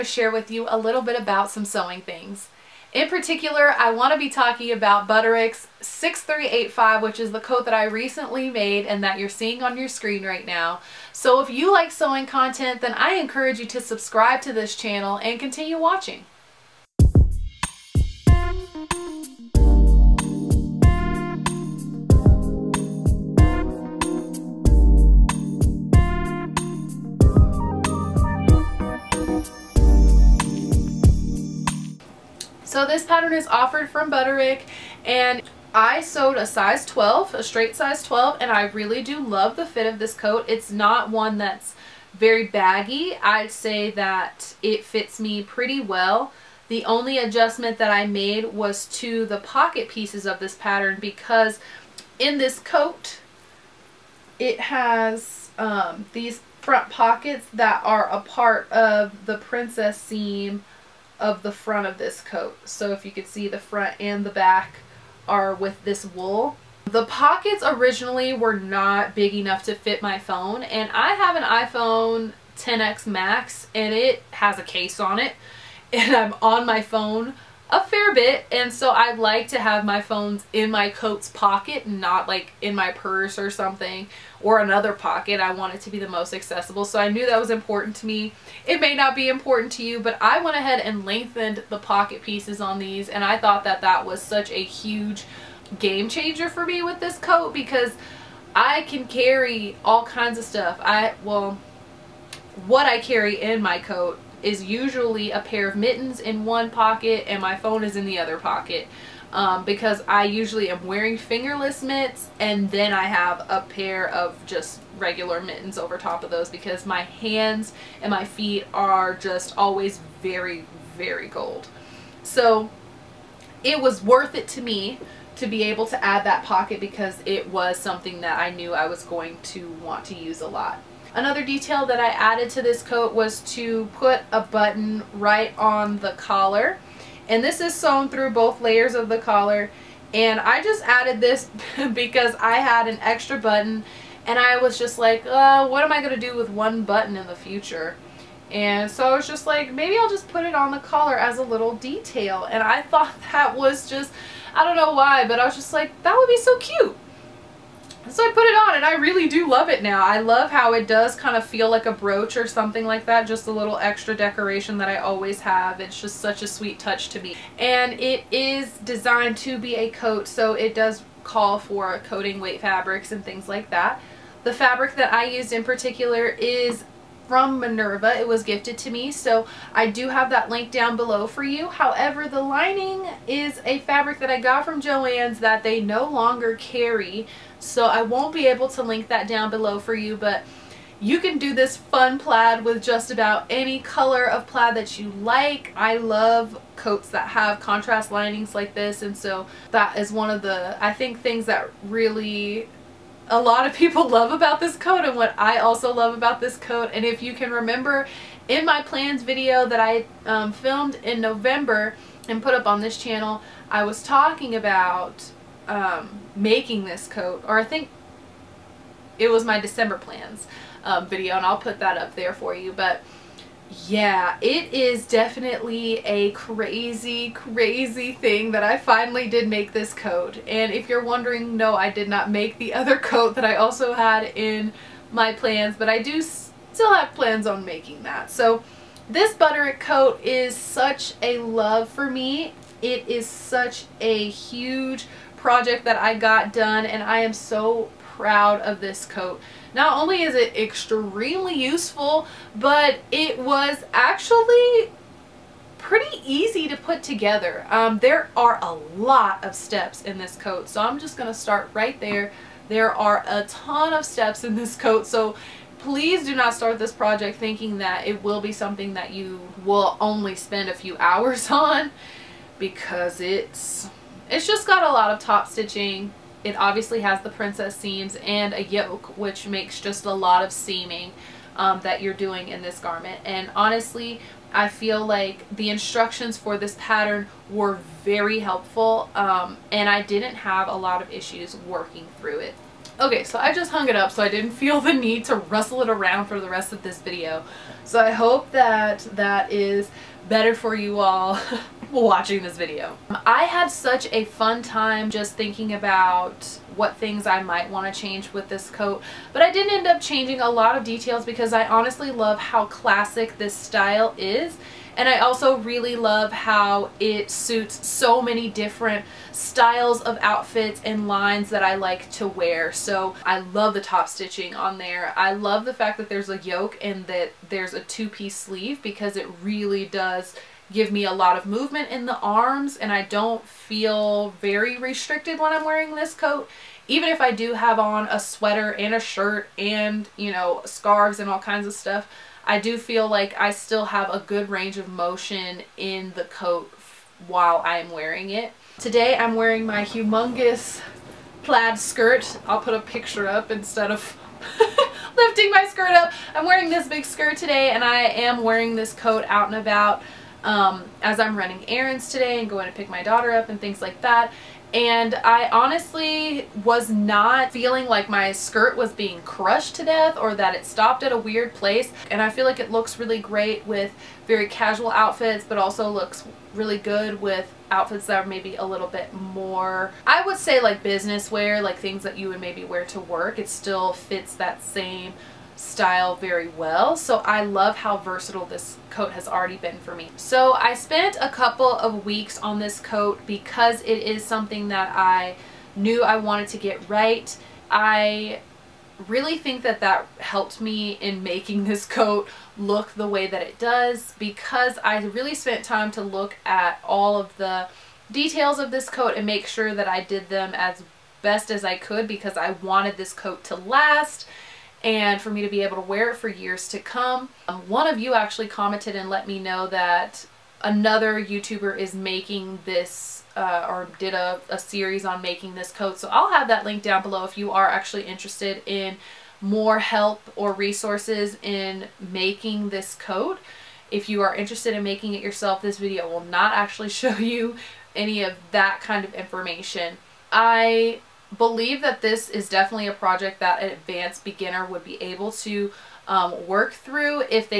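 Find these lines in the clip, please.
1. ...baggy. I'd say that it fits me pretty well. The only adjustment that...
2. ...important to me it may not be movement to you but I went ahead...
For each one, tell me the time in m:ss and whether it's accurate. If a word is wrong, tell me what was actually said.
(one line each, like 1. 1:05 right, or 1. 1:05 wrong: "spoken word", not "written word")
1. 0:42 right
2. 1:27 wrong: "important", not "movement".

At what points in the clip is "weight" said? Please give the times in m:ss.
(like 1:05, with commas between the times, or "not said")
2:52.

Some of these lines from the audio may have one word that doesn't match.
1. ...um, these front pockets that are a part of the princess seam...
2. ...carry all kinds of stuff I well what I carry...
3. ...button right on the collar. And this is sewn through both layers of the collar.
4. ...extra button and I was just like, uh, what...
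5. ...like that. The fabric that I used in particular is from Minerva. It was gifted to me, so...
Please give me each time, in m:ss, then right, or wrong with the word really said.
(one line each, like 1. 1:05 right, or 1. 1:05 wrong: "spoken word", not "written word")
1. 0:55 right
2. 1:39 right
3. 2:14 right
4. 2:23 right
5. 2:53 right.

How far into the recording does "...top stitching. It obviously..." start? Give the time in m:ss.
4:35.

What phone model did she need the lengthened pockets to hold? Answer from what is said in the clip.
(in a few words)
iPhone 10X Max.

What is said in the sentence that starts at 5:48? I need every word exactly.
Today I'm wearing my humongous plaid skirt.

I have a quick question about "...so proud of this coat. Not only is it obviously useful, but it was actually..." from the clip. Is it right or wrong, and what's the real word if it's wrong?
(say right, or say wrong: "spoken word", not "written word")
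wrong: "extremely", not "obviously".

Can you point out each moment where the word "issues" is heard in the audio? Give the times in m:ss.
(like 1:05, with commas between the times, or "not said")
4:51.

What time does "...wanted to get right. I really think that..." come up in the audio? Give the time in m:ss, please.
6:36.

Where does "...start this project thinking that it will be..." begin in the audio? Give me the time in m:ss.
4:26.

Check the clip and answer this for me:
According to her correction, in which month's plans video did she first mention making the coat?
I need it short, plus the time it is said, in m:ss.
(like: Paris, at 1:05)
December, at 3:39.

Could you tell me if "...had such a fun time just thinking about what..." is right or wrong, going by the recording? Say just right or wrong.
right.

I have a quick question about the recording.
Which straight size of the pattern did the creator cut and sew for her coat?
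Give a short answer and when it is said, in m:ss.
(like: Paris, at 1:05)
12, at 0:37.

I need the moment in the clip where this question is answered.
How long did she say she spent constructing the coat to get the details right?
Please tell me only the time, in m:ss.
6:31.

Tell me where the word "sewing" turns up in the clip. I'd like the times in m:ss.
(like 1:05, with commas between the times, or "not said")
0:01, 0:11.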